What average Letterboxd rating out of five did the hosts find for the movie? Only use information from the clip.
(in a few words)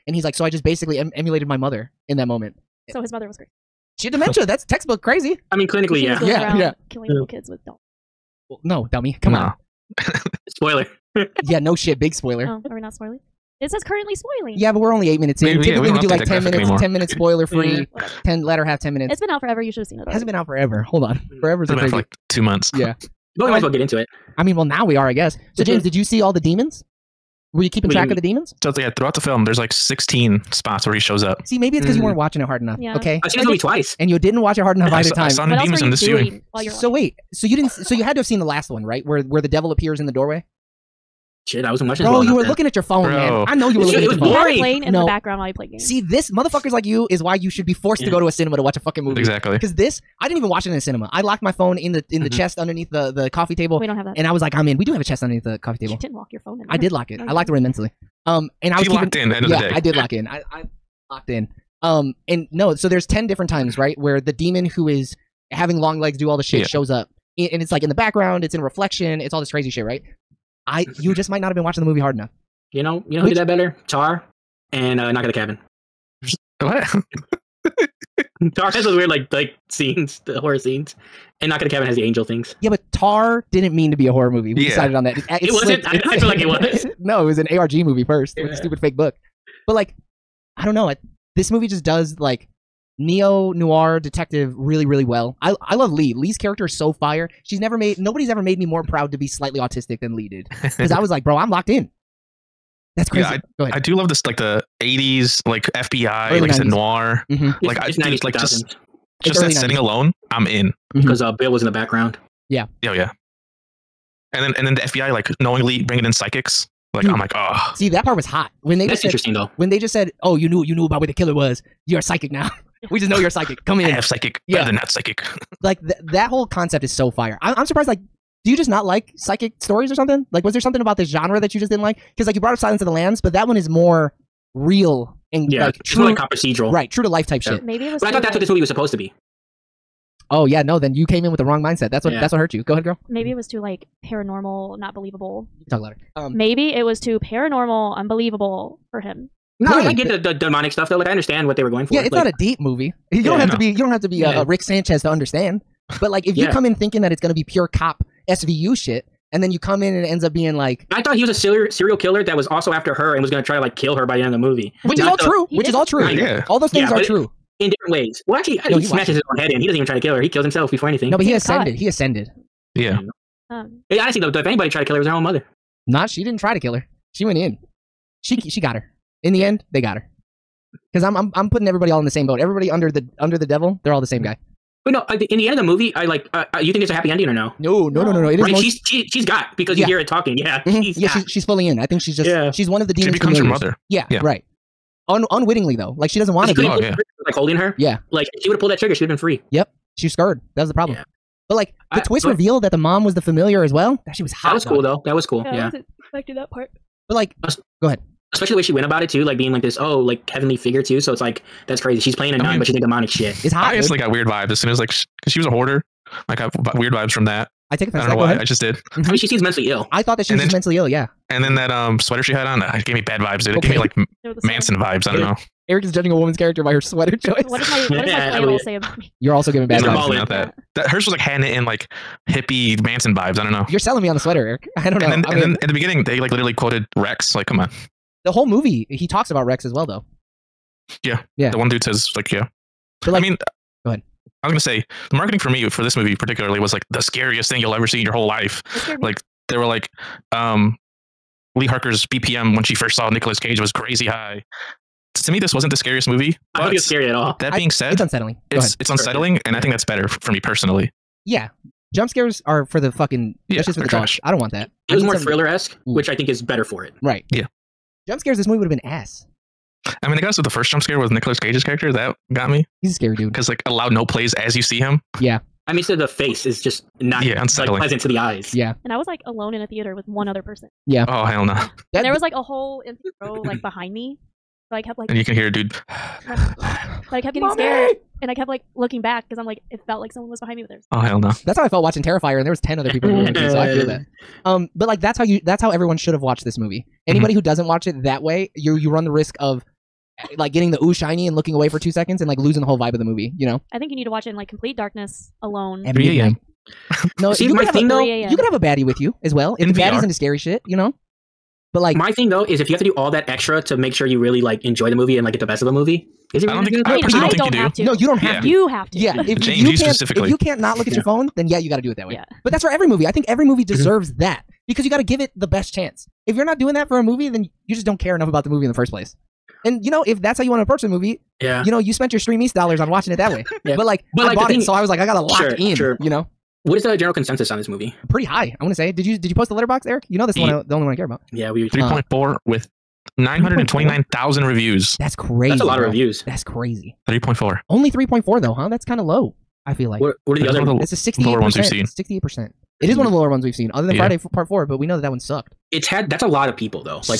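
3.4.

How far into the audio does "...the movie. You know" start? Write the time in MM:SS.
05:02.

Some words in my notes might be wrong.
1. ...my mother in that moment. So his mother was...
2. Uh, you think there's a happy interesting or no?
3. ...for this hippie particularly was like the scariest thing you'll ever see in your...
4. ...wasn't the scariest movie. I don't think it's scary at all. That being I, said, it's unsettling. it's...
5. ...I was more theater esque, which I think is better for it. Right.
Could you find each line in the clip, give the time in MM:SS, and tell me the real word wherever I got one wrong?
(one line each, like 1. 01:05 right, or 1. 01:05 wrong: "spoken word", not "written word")
1. 00:01 right
2. 03:06 wrong: "ending", not "interesting"
3. 04:05 wrong: "movie", not "hippie"
4. 04:15 right
5. 04:24 wrong: "thriller", not "theater".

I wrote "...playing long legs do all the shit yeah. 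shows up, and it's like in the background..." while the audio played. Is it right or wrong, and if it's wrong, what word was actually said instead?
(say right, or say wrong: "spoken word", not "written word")
wrong: "having", not "playing".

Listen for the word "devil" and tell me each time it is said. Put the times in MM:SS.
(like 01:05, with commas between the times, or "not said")
00:39, 03:03.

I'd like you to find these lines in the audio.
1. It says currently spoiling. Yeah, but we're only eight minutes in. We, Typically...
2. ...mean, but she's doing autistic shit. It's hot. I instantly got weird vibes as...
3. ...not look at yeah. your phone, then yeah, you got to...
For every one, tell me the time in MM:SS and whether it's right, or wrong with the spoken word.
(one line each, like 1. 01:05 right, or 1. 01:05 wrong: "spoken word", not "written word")
1. 00:13 right
2. 03:32 wrong: "demonic", not "autistic"
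3. 05:20 right.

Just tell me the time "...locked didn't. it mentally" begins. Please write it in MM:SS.
00:57.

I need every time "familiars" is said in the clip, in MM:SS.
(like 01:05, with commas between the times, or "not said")
03:13, 03:23.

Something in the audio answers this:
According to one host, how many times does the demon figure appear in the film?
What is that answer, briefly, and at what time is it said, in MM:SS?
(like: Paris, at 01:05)
16, at 00:29.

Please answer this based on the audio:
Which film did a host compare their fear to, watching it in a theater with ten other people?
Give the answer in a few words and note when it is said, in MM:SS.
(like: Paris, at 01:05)
Terrifier, at 04:52.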